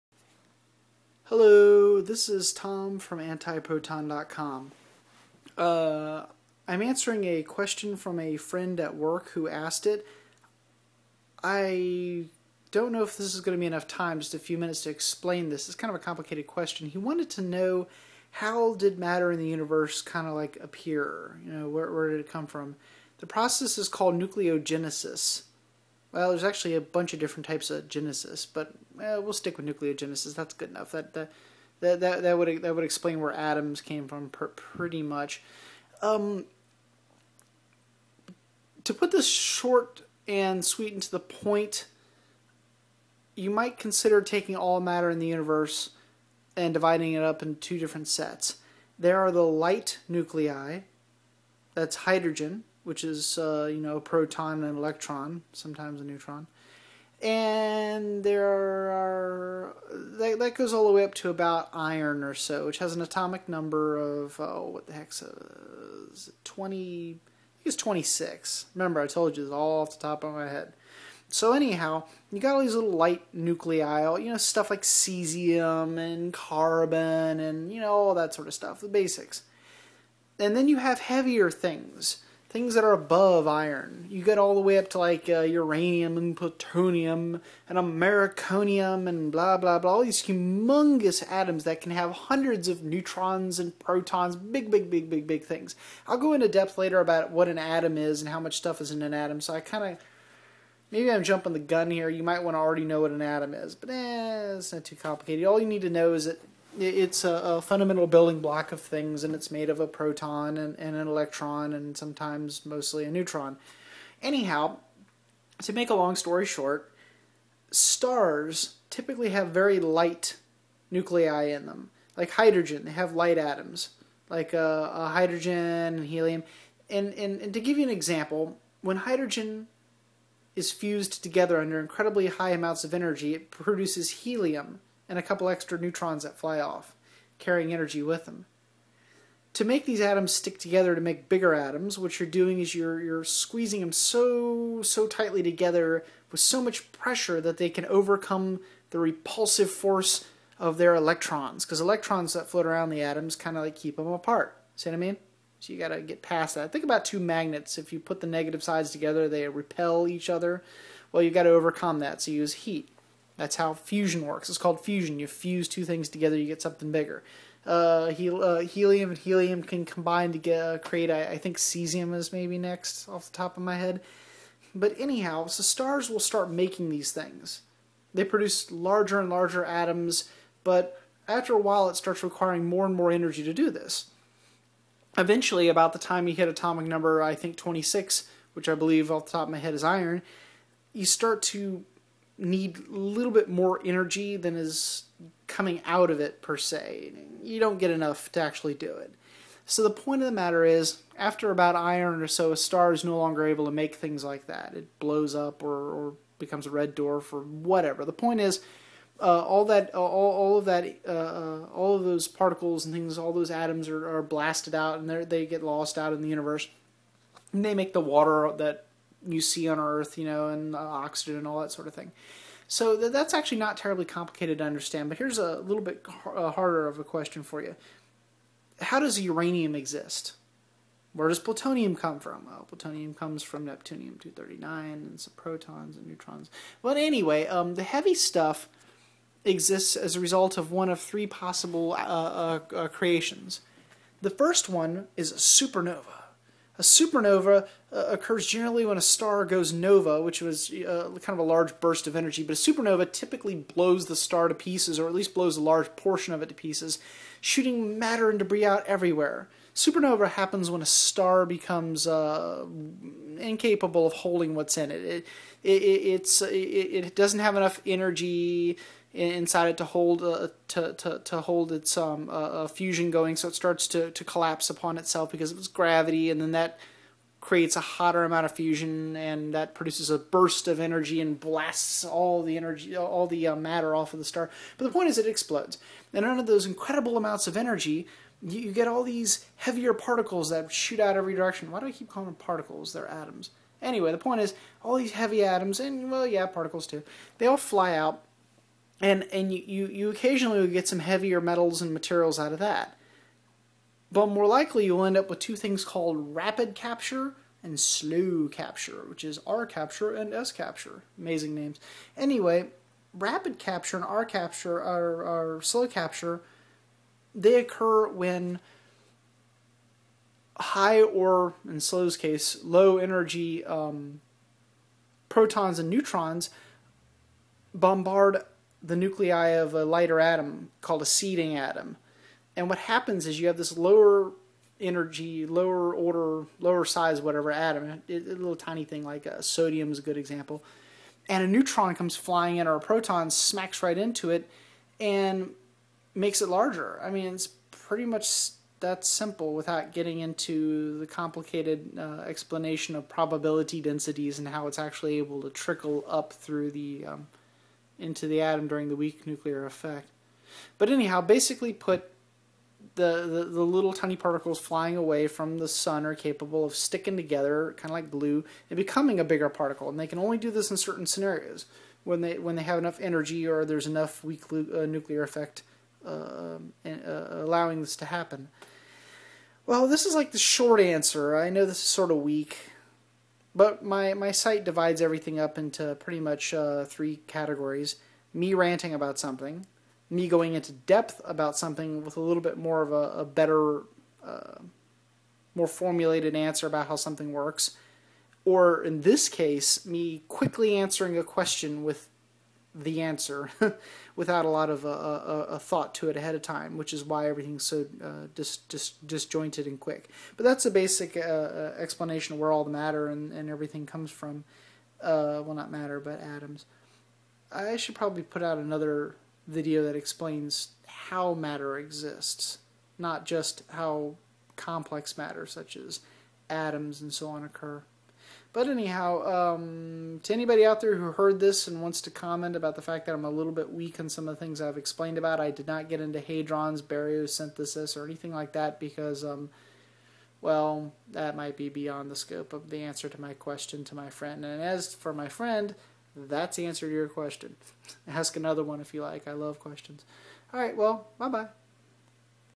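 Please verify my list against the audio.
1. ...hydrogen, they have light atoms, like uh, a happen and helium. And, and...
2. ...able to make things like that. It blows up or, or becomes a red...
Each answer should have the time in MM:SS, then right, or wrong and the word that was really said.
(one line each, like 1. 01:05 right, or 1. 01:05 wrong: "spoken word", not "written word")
1. 02:02 wrong: "hydrogen", not "happen"
2. 03:23 right.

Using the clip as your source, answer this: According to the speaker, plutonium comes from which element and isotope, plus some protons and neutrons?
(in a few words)
neptunium-239.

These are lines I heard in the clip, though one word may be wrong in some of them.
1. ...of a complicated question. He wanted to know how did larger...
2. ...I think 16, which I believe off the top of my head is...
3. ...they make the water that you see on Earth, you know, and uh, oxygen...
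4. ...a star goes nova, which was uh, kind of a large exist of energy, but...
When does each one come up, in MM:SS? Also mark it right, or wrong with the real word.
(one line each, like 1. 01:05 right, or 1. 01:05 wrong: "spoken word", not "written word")
1. 00:15 wrong: "matter", not "larger"
2. 03:07 wrong: "26", not "16"
3. 03:37 right
4. 04:08 wrong: "burst", not "exist".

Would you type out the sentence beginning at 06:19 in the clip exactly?
Well, this is like the short answer.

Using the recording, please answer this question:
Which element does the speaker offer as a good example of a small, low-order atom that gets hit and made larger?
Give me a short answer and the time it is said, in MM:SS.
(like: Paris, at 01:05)
sodium, at 05:39.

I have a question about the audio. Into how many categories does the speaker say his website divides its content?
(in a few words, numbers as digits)
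3.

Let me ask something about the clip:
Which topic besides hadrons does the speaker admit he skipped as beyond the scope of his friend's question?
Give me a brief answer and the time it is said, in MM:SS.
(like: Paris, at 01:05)
baryosynthesis, at 07:16.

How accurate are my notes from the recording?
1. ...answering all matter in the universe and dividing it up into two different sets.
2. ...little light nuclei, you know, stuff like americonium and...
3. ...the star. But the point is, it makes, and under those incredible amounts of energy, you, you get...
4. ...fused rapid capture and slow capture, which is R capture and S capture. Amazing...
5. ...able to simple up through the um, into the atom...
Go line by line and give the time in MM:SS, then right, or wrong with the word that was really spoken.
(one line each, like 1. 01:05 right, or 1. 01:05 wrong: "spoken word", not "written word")
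1. 00:44 wrong: "taking", not "answering"
2. 01:12 wrong: "cesium", not "americonium"
3. 04:44 wrong: "explodes", not "makes"
4. 05:05 wrong: "called", not "fused"
5. 05:55 wrong: "trickle", not "simple".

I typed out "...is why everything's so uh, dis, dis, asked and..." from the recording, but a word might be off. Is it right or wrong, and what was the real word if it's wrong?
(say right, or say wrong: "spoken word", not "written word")
wrong: "disjointed", not "asked".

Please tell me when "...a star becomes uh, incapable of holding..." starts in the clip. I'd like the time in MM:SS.
04:20.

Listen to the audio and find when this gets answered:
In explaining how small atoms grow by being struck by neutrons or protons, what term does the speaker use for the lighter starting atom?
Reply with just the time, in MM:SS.
05:31.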